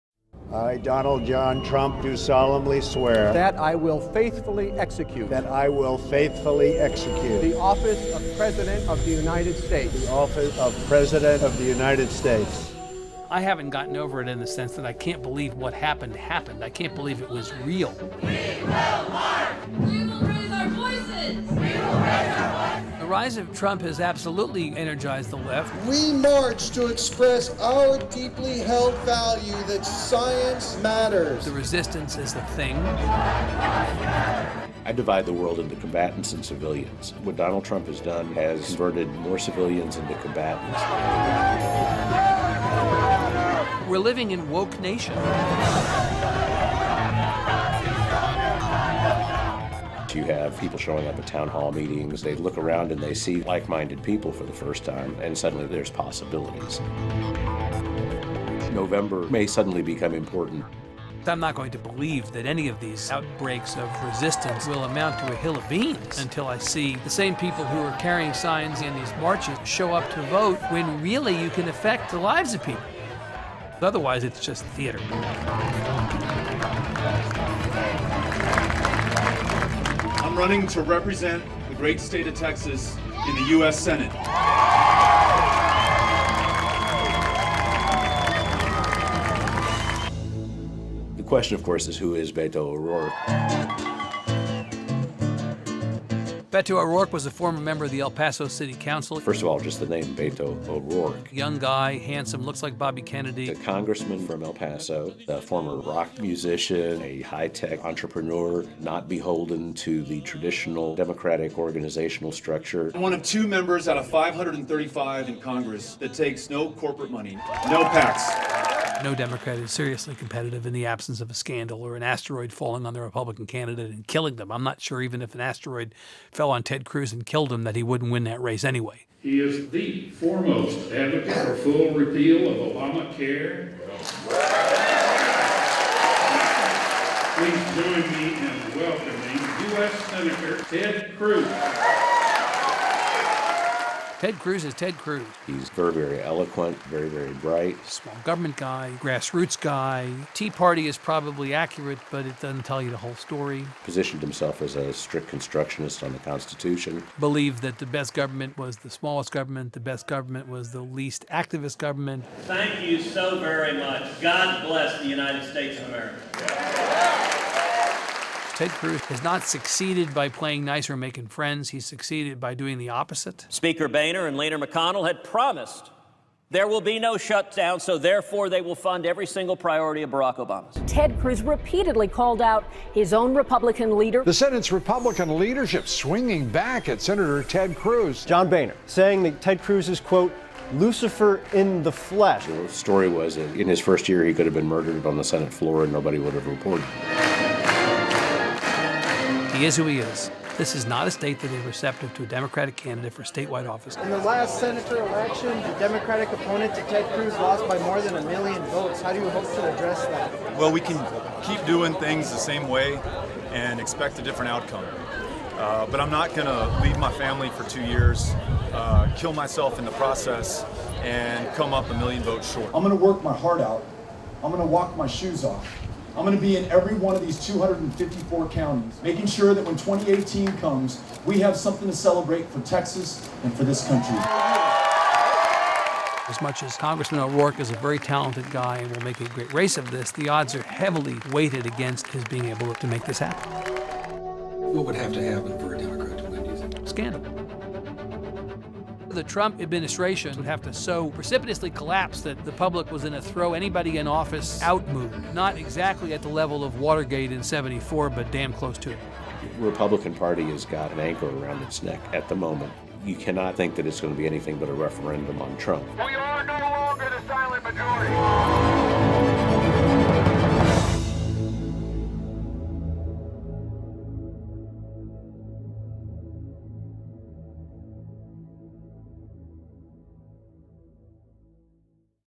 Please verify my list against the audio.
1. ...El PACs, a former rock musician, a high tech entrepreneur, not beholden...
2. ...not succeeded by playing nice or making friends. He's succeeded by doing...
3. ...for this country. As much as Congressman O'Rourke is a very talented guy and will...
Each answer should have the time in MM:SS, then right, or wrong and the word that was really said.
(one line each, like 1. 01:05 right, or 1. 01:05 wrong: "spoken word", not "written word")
1. 01:44 wrong: "Paso", not "PACs"
2. 02:49 right
3. 03:53 right.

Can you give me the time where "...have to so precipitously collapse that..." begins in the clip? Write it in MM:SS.
04:10.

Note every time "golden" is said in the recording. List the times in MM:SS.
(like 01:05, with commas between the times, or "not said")
not said.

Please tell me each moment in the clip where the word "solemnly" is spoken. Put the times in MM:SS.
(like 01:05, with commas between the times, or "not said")
00:02.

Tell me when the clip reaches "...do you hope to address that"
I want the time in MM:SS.
03:29.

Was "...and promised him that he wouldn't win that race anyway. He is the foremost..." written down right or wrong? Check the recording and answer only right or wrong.
wrong.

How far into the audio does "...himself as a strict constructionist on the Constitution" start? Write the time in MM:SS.
02:34.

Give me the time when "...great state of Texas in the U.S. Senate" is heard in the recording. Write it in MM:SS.
01:21.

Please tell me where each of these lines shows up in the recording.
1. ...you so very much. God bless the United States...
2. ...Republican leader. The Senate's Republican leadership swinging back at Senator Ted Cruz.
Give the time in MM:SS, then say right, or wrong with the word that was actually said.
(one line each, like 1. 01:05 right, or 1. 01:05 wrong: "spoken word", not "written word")
1. 02:42 right
2. 03:03 right.